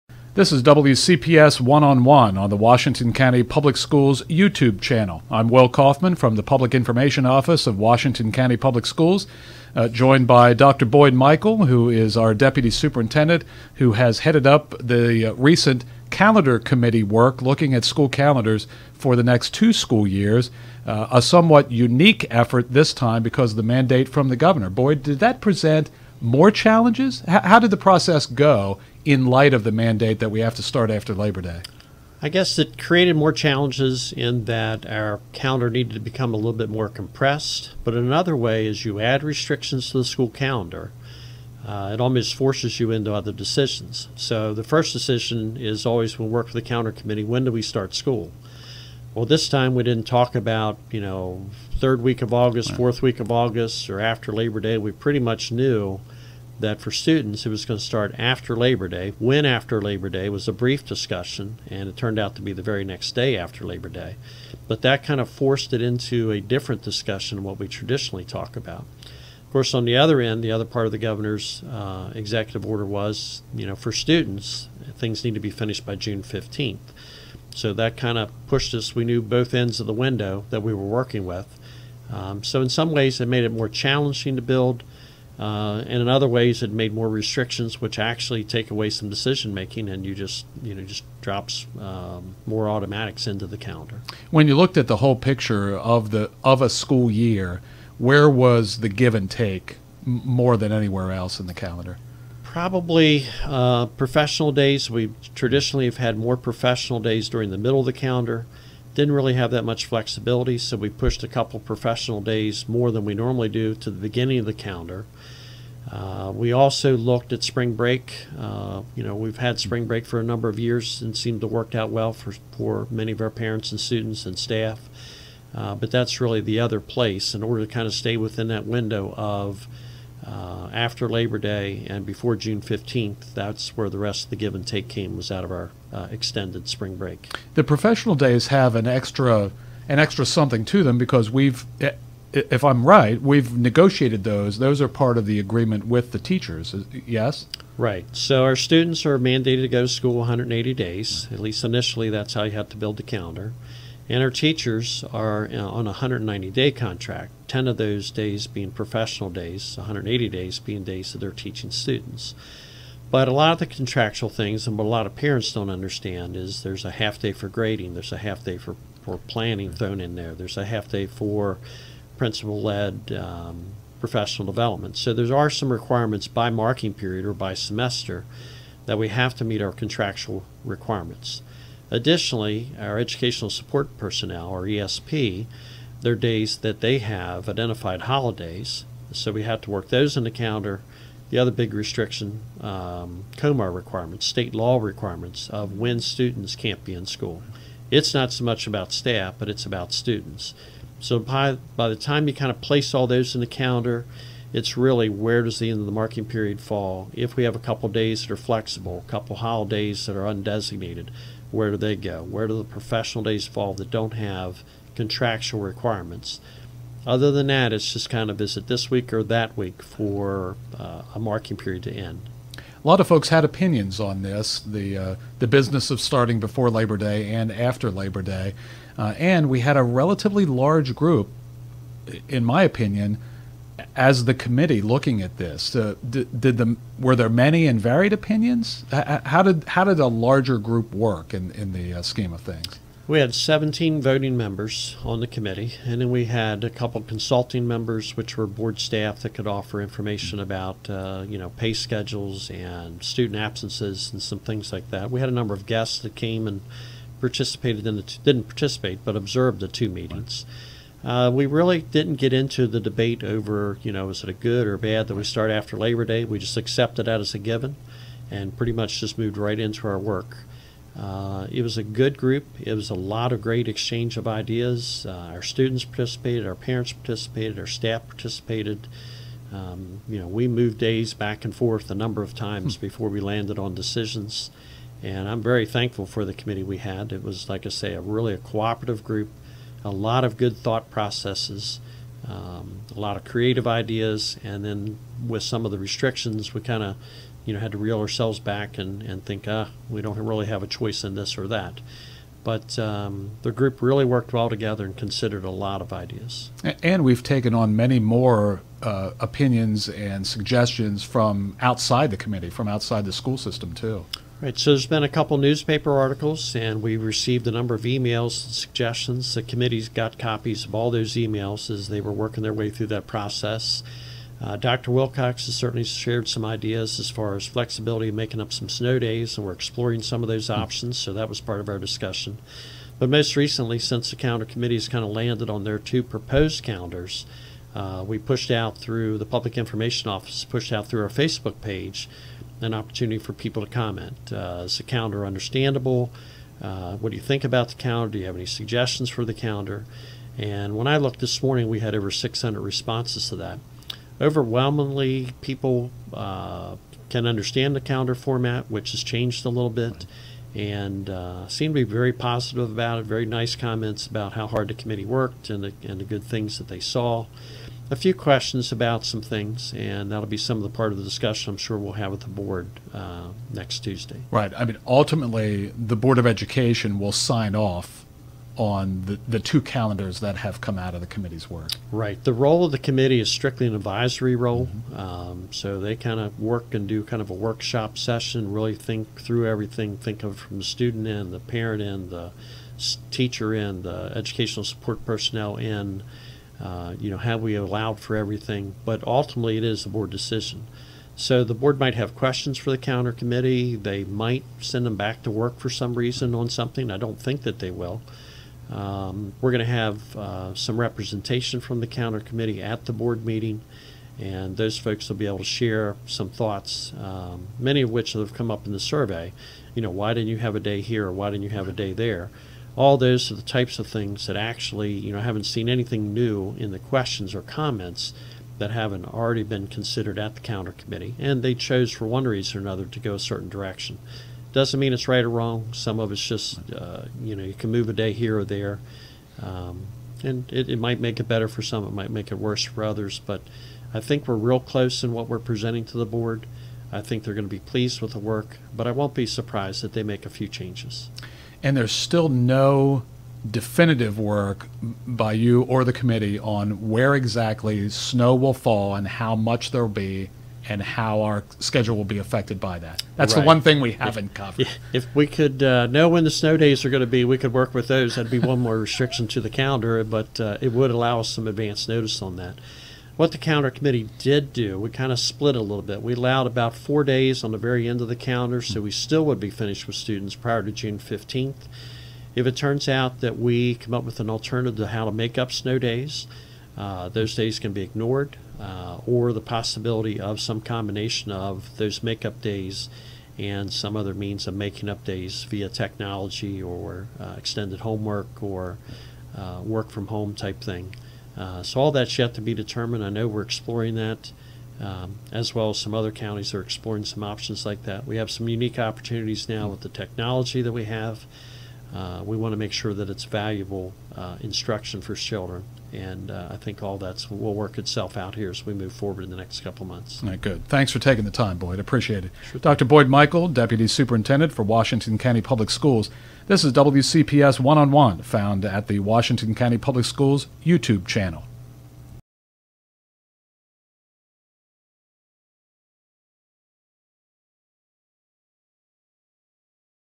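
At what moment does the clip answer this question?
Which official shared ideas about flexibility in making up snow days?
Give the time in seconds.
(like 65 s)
324 s.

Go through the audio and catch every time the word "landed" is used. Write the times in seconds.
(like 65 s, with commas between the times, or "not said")
283 s, 335 s.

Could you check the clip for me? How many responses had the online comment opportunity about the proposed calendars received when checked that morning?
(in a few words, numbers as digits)
over 600.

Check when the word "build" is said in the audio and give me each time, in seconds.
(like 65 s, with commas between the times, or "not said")
84 s, 152 s.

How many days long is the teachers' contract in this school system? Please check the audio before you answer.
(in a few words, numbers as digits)
190.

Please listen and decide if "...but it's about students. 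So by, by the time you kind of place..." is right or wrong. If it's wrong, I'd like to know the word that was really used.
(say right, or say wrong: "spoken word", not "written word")
right.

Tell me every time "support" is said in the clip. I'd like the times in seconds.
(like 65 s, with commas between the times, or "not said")
183 s, 394 s.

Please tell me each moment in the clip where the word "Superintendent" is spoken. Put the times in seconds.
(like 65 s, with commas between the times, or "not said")
12 s, 523 s.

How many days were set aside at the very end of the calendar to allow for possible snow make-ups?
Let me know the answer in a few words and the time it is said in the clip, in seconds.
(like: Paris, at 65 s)
4, at 476 s.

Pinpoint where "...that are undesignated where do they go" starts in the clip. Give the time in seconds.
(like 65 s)
210 s.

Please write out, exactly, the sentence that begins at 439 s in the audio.
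Um, and it, it might make it better for some, it might make it worse for others.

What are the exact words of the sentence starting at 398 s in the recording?
But ultimately, it is the board decision.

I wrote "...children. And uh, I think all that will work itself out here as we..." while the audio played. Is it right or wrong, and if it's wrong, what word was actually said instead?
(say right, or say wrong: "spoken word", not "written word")
right.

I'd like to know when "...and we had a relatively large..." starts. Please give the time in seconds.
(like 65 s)
229 s.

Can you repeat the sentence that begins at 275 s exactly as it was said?
Uh, our students participated, our parents participated, our staff participated.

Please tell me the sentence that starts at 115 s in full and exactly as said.
Uh, we also looked at spring break.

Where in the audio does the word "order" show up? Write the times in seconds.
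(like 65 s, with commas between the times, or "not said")
72 s, 127 s.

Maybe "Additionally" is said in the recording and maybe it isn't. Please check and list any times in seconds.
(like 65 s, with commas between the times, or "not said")
181 s.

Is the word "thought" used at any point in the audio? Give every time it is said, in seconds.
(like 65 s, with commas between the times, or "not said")
290 s, 416 s.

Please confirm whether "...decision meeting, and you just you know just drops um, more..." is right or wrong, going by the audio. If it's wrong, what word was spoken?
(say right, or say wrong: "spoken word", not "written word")
wrong: "making", not "meeting".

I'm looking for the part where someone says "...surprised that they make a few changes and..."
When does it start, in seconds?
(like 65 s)
449 s.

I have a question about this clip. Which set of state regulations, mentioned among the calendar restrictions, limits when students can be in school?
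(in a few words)
COMAR.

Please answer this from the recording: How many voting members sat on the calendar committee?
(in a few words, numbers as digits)
17.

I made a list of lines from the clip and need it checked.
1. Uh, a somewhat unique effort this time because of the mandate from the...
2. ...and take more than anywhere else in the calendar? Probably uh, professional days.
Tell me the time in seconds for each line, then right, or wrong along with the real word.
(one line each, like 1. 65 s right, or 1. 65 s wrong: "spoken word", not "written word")
1. 20 s right
2. 99 s right.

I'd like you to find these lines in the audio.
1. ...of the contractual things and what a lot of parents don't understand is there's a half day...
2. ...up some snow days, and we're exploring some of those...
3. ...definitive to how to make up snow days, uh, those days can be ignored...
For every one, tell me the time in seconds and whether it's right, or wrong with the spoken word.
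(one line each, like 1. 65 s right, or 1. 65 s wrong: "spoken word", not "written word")
1. 163 s right
2. 328 s right
3. 484 s wrong: "alternative", not "definitive".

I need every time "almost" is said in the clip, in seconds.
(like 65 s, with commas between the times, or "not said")
42 s.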